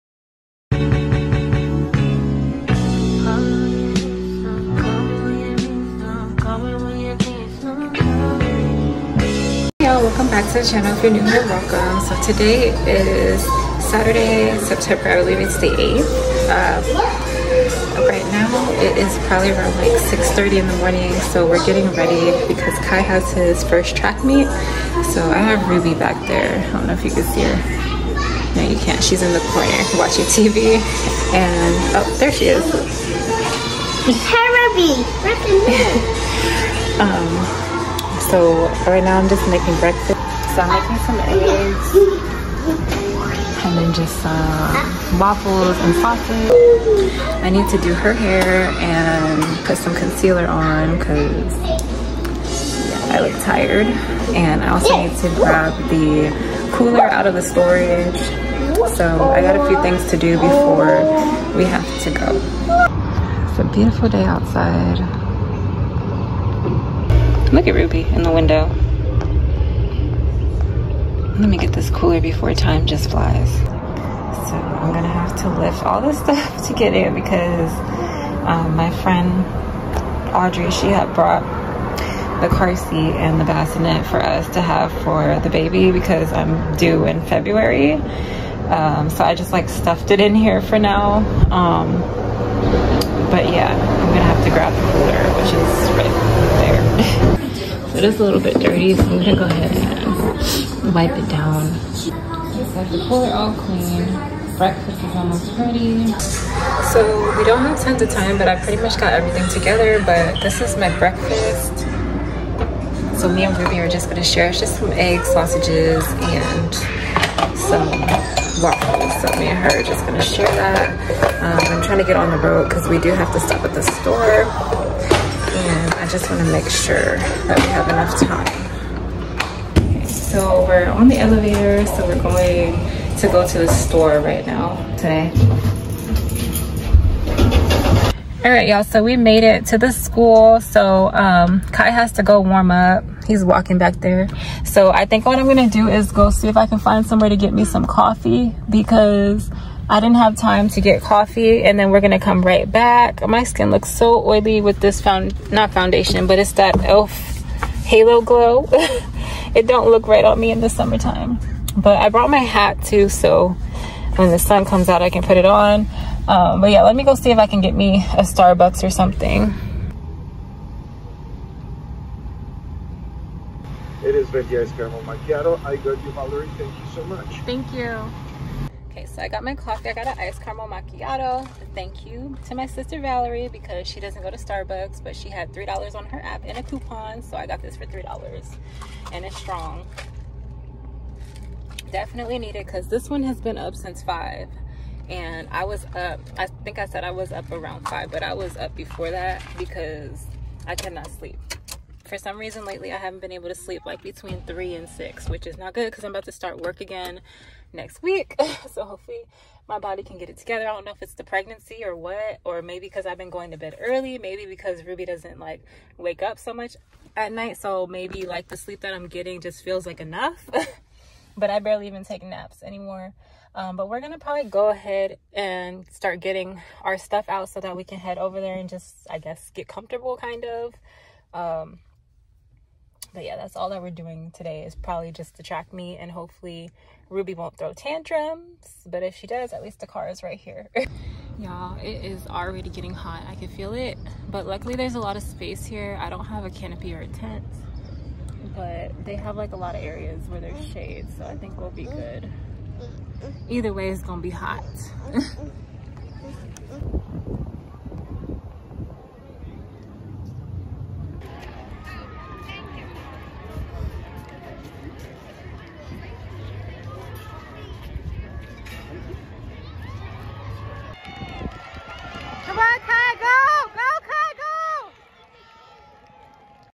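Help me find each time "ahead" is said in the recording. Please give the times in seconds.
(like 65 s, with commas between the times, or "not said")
99 s, 224 s.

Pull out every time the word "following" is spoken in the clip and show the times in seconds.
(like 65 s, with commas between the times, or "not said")
not said.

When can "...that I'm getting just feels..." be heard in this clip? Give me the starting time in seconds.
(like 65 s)
218 s.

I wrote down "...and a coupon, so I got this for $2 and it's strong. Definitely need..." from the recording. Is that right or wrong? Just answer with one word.
wrong.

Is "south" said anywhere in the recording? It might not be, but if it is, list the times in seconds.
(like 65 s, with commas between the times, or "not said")
not said.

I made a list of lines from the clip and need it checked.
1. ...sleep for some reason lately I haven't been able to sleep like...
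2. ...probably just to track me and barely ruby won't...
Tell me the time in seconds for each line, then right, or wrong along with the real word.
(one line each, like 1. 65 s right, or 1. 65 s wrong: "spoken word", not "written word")
1. 201 s right
2. 234 s wrong: "hopefully", not "barely".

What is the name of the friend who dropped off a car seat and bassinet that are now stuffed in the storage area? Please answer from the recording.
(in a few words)
Audrey.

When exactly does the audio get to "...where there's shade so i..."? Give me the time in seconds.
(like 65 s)
250 s.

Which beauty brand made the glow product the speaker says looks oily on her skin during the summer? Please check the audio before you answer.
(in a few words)
e.l.f.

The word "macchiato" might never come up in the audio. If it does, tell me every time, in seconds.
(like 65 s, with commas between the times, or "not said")
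175 s, 180 s.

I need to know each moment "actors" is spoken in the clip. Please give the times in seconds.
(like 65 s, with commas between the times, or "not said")
not said.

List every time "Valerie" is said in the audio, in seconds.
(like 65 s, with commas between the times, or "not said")
176 s, 182 s.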